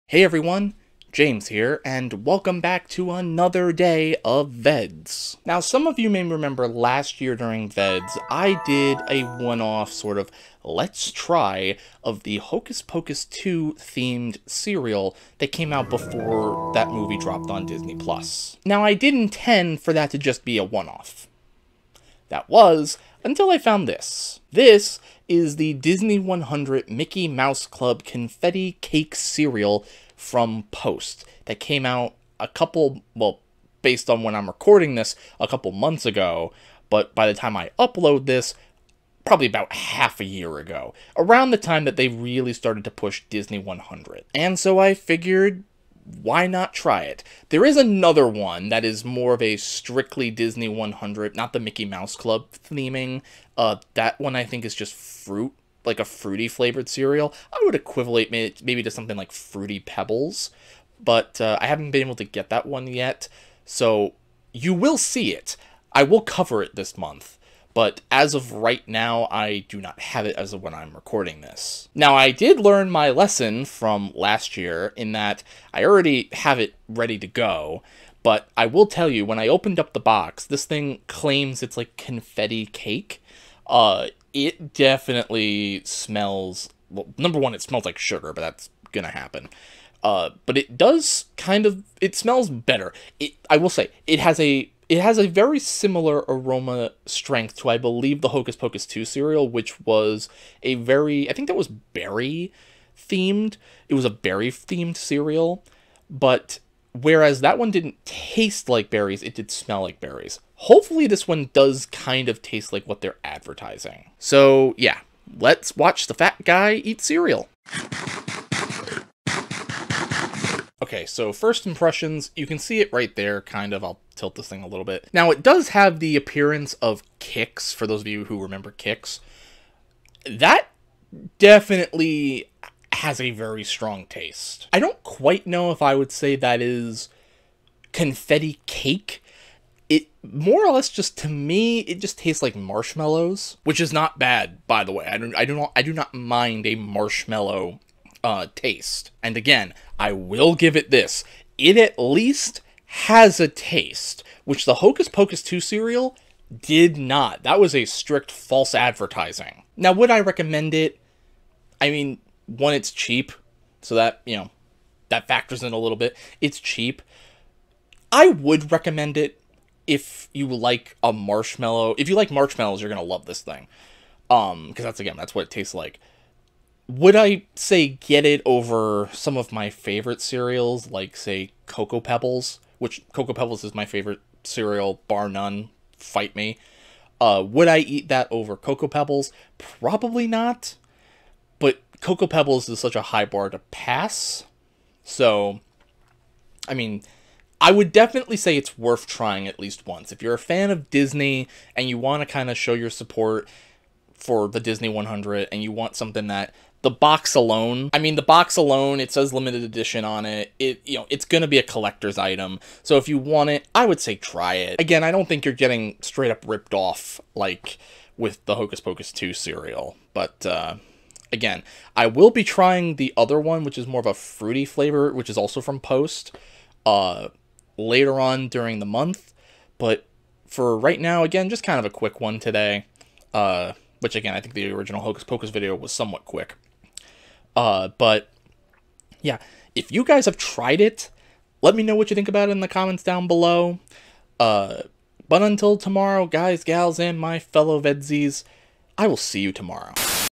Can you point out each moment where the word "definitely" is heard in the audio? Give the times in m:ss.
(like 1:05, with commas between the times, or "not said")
1:24, 2:11, 3:17.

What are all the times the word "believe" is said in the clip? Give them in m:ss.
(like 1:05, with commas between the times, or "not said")
1:37.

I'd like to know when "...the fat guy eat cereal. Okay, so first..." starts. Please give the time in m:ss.
1:56.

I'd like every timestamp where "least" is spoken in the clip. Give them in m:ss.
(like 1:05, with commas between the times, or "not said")
2:31, 3:19.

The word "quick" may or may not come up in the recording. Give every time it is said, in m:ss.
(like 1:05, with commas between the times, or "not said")
3:51, 3:56.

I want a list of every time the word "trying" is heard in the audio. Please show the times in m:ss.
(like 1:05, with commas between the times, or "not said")
3:19, 3:42.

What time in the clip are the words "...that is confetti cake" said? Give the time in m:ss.
2:16.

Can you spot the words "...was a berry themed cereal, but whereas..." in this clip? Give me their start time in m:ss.
1:43.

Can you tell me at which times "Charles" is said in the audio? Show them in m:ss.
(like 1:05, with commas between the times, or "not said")
not said.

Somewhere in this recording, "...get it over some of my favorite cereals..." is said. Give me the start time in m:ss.
2:57.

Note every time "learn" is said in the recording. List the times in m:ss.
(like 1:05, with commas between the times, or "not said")
1:12.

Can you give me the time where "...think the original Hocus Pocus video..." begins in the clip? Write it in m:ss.
3:54.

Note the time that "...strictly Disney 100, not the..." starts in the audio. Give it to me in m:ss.
0:49.